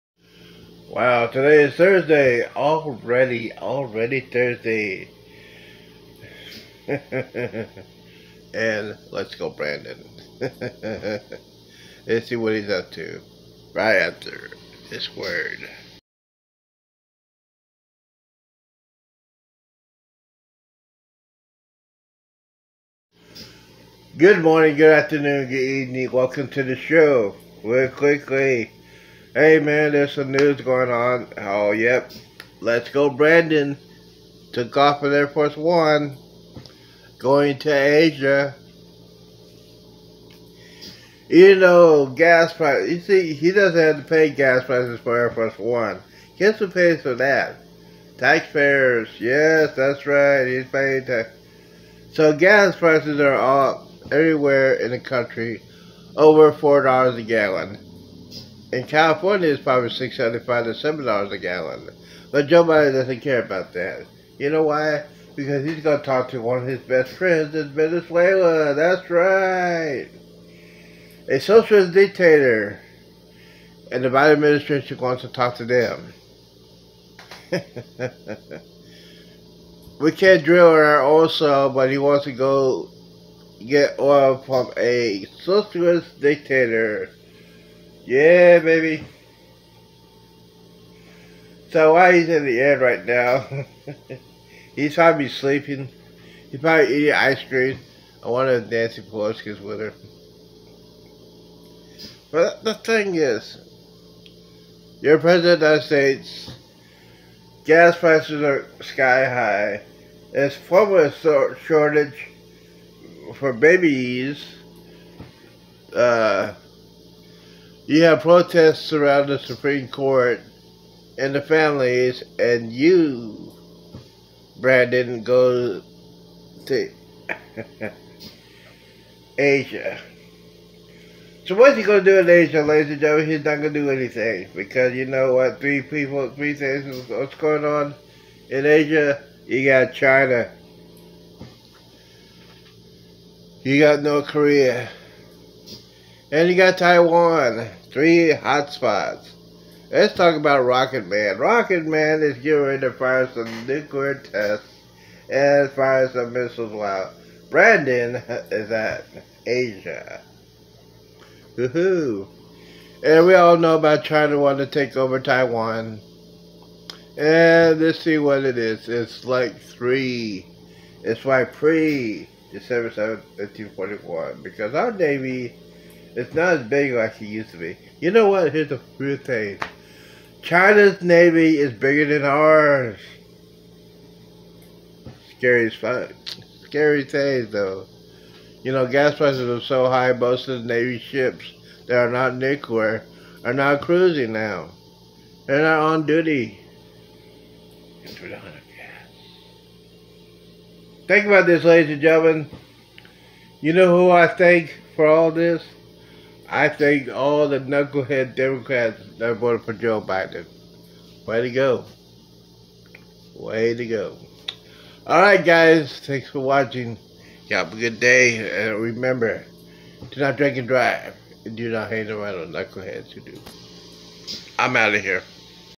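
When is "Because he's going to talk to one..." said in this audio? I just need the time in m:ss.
1:05.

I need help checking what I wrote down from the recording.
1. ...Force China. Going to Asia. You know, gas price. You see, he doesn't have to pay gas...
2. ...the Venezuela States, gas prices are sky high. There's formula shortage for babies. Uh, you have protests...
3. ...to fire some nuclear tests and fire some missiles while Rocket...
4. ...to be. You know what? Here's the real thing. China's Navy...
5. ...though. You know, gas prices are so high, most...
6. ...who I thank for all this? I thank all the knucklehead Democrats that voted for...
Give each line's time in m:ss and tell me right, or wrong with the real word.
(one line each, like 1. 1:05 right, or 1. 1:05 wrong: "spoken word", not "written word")
1. 0:35 wrong: "One", not "China"
2. 1:45 wrong: "United", not "Venezuela"
3. 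2:32 wrong: "Brandon", not "Rocket"
4. 2:57 right
5. 3:07 right
6. 3:23 right.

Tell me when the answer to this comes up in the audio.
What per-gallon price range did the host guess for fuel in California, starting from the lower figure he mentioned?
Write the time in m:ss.
0:59.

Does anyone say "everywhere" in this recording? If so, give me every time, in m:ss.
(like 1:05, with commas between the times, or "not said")
0:54.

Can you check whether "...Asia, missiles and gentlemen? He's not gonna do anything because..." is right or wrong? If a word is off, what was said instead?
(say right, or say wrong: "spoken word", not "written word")
wrong: "ladies", not "missiles".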